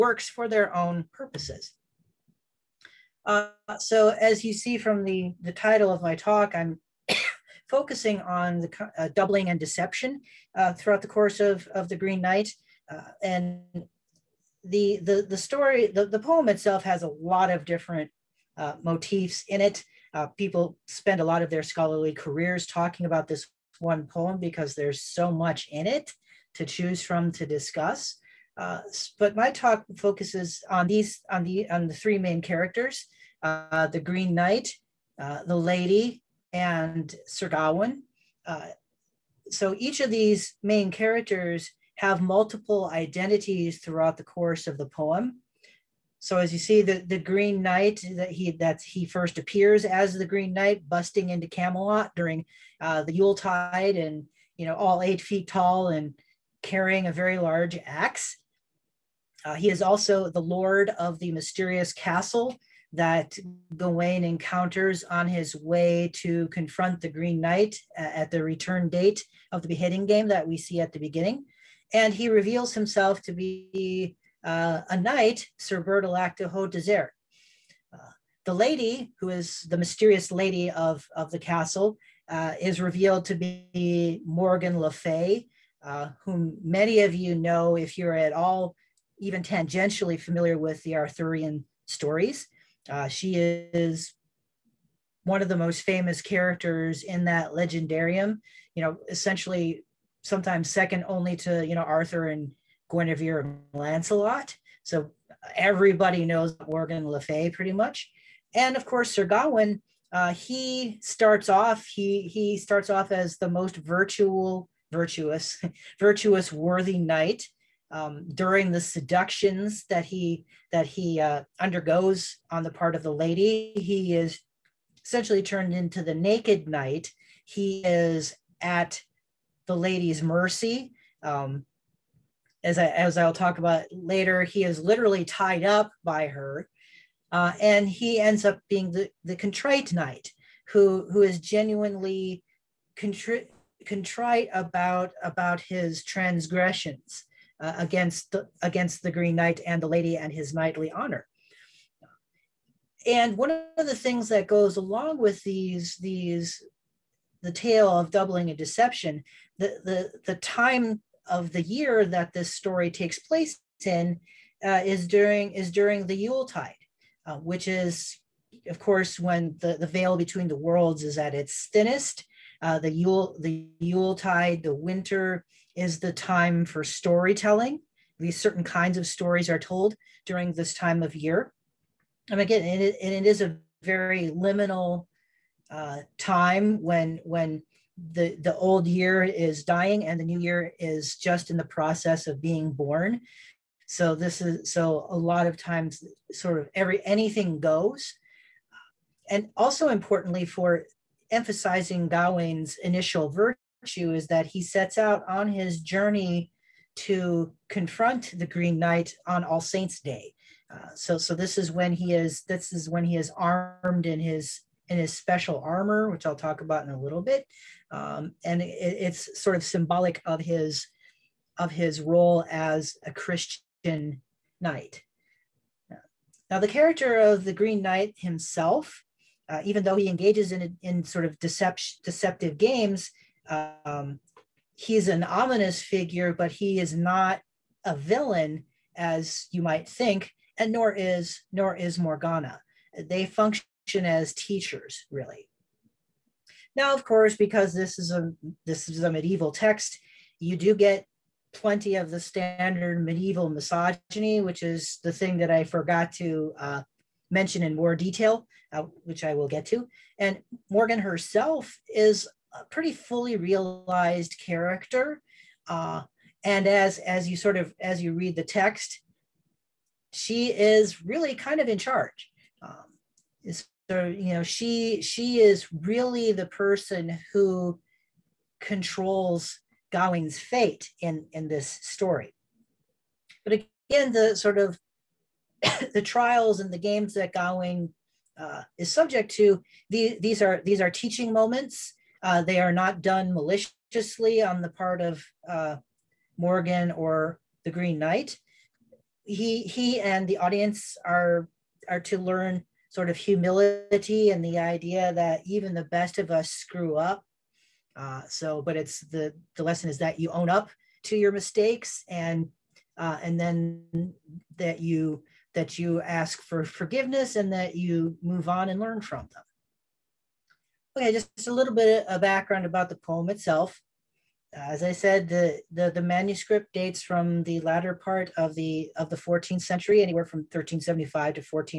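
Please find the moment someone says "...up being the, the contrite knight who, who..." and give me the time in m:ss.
2:18.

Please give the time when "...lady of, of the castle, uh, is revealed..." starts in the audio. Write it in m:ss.
1:20.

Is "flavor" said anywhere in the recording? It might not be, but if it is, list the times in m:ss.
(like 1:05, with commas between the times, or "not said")
not said.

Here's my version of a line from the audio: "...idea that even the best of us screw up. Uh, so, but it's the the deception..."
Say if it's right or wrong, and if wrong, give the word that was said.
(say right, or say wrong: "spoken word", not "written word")
wrong: "lesson", not "deception".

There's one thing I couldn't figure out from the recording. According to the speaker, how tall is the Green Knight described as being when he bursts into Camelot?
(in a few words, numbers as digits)
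8 feet.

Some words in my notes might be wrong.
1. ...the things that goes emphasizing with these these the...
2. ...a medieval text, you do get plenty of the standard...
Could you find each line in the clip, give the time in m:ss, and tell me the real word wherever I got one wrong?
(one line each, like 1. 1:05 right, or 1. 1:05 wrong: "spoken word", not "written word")
1. 2:33 wrong: "along", not "emphasizing"
2. 4:09 right.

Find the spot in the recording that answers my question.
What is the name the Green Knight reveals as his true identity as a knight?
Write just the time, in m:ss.
1:15.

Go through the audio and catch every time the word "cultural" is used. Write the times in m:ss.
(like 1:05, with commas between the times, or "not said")
not said.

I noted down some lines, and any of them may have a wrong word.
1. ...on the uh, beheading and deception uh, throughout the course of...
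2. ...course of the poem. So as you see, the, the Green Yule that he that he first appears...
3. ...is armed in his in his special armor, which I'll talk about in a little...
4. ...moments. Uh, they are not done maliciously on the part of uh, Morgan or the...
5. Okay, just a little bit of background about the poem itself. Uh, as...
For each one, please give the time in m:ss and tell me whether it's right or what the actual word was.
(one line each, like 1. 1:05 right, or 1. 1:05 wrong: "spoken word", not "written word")
1. 0:08 wrong: "doubling", not "beheading"
2. 0:44 wrong: "Knight", not "Yule"
3. 3:33 right
4. 4:51 right
5. 5:20 right.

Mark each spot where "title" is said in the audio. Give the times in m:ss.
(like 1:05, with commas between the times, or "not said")
0:05.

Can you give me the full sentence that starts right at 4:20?
And Morgan herself is a pretty fully realized character.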